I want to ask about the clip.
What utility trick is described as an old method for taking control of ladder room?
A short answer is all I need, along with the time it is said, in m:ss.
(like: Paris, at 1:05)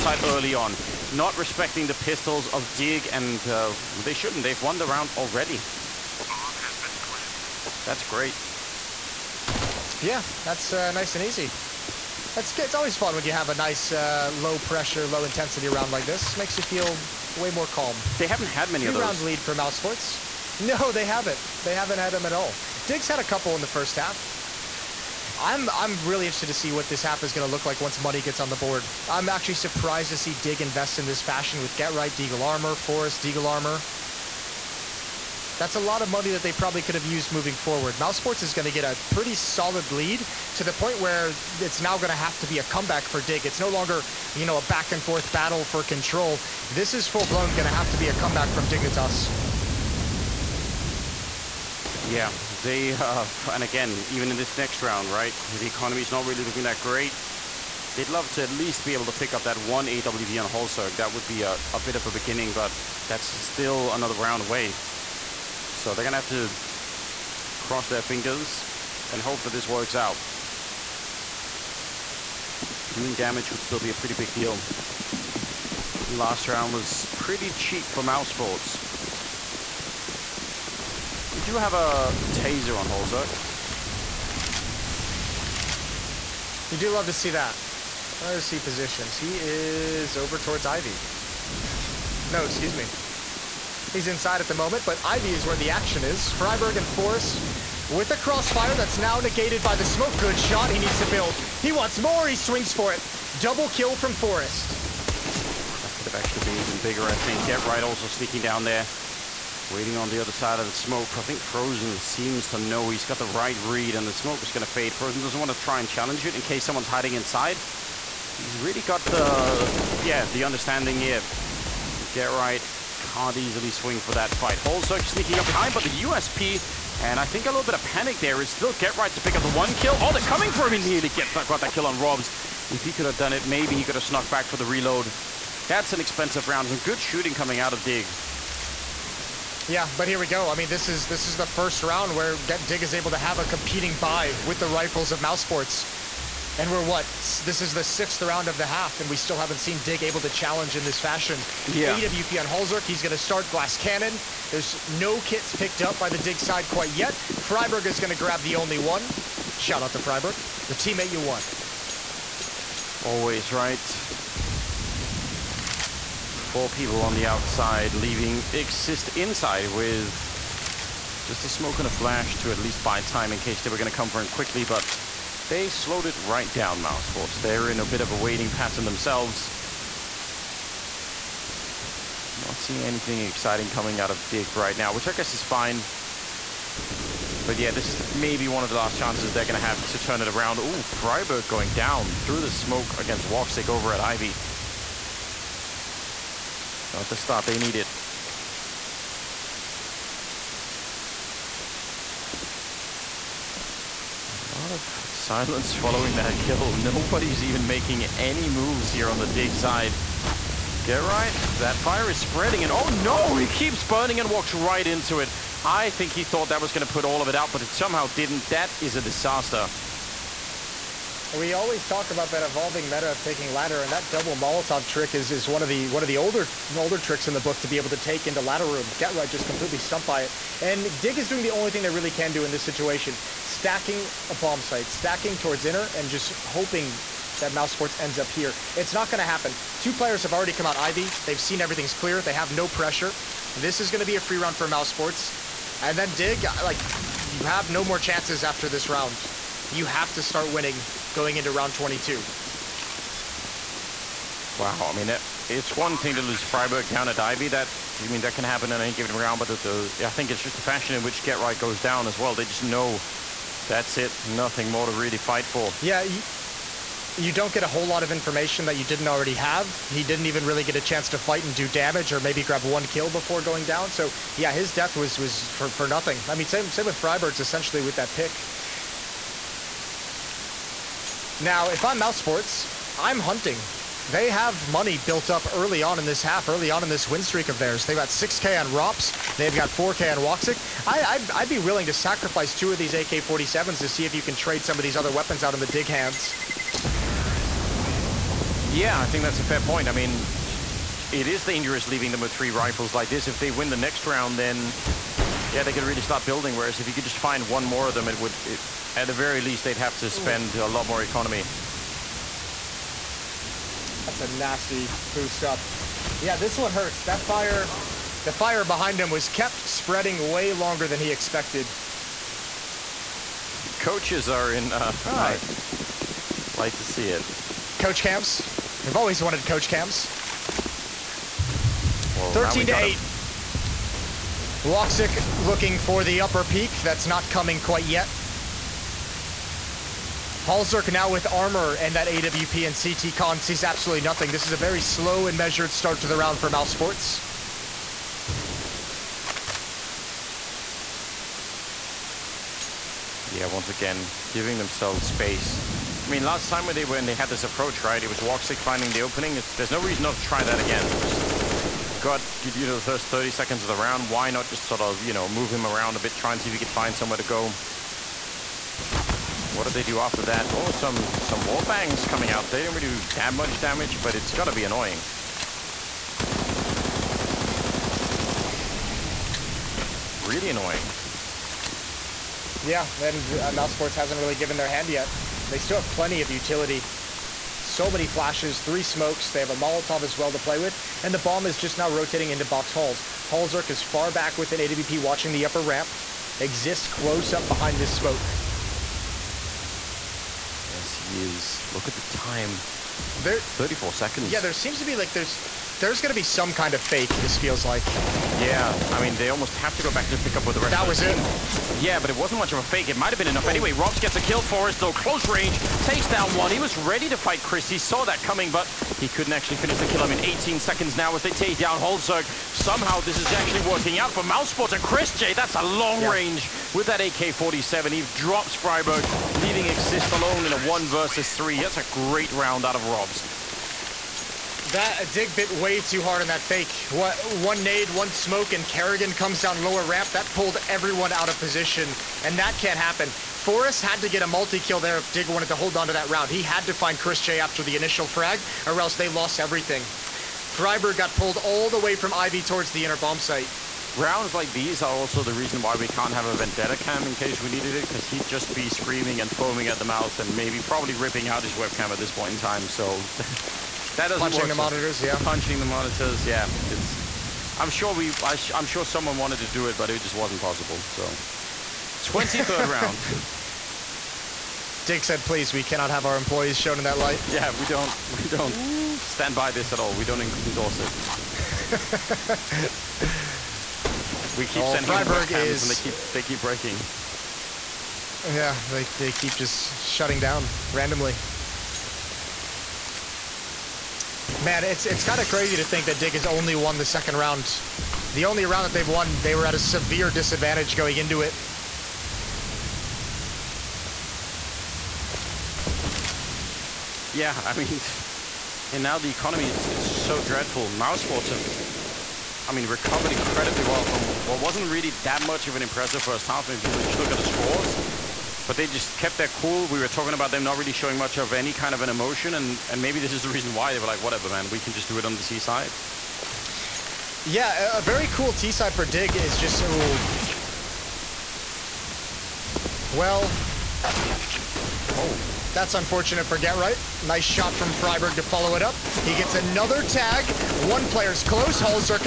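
double Molotov, at 3:44.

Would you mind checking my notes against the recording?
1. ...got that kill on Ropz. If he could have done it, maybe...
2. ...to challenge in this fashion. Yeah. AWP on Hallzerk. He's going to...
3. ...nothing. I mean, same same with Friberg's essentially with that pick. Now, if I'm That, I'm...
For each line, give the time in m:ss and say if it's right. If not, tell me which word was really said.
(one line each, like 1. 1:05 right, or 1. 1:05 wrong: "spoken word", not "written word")
1. 2:11 right
2. 2:30 right
3. 4:35 wrong: "Mousesports", not "That".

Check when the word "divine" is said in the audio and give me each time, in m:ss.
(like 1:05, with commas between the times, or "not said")
not said.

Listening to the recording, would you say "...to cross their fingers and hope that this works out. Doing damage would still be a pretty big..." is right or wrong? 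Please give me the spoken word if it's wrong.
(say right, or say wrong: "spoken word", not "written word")
right.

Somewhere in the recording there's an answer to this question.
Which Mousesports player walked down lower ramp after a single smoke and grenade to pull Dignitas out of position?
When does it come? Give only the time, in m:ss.
7:18.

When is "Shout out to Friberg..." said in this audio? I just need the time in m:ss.
2:39.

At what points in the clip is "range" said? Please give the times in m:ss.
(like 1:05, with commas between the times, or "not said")
6:55, 7:06.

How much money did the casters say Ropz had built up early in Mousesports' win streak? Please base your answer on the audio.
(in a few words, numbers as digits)
6K.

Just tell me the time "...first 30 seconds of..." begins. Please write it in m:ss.
6:02.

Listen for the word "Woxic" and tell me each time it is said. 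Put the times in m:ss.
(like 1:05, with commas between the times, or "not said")
3:13, 4:50, 5:34, 5:58.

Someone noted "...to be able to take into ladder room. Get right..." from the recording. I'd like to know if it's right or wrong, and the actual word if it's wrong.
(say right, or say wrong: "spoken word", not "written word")
right.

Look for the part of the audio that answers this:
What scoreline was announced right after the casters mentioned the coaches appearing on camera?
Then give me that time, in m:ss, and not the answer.
5:32.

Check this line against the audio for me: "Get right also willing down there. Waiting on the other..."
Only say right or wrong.
wrong.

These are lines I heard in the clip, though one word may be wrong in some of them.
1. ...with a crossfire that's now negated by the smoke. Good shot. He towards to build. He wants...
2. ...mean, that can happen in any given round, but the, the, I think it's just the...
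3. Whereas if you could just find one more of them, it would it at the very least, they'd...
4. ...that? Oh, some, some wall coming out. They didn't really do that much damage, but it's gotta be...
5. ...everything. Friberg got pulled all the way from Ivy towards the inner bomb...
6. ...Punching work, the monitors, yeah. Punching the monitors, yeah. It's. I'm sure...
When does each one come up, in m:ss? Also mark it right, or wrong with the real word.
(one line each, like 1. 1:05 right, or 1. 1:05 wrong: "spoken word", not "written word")
1. 1:37 wrong: "needs", not "towards"
2. 4:18 right
3. 5:06 right
4. 6:10 right
5. 7:29 right
6. 7:44 right.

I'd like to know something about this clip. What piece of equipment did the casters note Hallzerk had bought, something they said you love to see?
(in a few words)
taser.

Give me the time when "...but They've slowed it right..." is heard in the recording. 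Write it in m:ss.
2:54.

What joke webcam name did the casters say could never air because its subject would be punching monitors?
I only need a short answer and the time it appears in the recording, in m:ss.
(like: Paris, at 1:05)
Vendetta cam, at 7:36.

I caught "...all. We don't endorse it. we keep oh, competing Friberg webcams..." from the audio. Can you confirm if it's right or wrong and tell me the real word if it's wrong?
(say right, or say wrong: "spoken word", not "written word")
wrong: "sending", not "competing".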